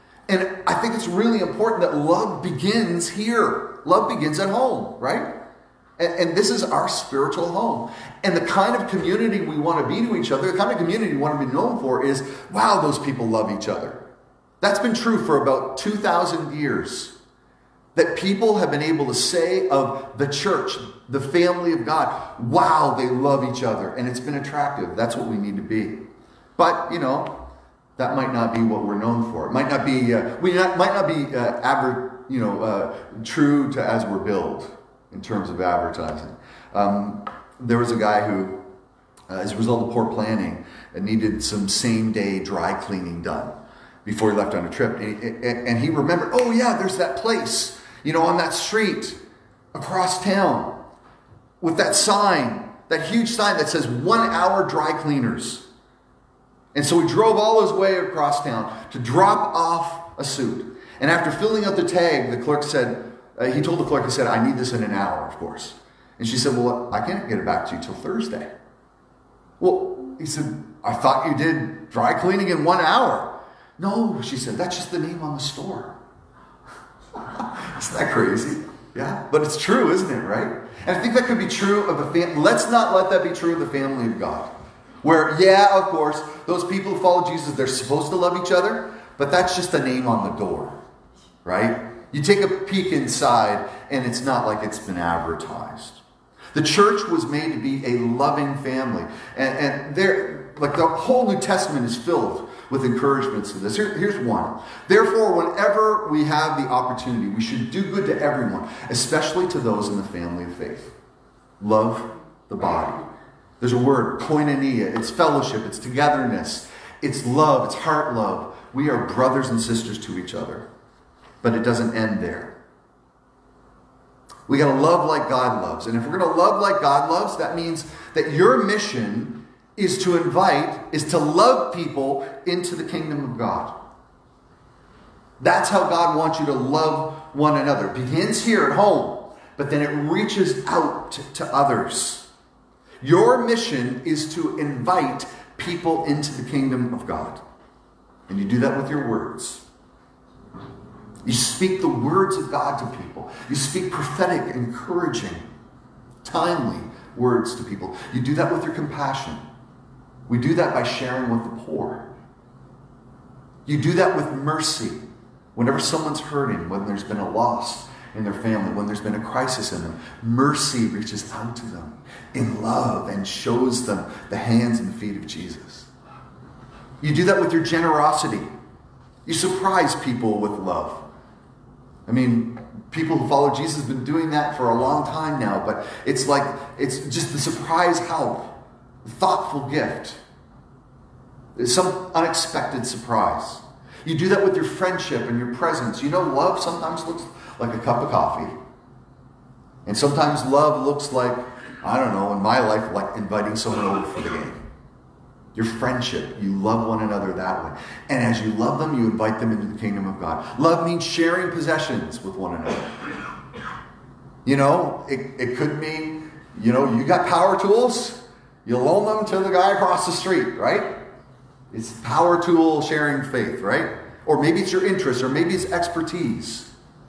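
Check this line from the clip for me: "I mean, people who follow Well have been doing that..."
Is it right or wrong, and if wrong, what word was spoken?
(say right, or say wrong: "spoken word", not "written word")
wrong: "Jesus", not "Well".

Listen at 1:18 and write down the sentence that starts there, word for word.
Yeah, but it's true, isn't it, right?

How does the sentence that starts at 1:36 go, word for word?
The church was made to be a loving family.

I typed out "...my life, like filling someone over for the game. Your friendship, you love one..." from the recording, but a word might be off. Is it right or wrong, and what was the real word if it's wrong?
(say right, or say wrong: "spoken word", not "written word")
wrong: "inviting", not "filling".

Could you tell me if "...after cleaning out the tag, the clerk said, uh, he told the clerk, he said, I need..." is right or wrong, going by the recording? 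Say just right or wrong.
wrong.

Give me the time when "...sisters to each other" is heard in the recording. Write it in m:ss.
1:59.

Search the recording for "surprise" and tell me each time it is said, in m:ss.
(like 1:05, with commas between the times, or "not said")
2:59, 3:07, 3:12.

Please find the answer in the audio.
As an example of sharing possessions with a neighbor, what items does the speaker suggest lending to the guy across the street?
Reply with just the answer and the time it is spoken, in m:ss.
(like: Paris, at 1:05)
Power tools, at 3:37.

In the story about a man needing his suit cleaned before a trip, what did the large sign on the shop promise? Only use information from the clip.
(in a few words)
One hour dry cleaners.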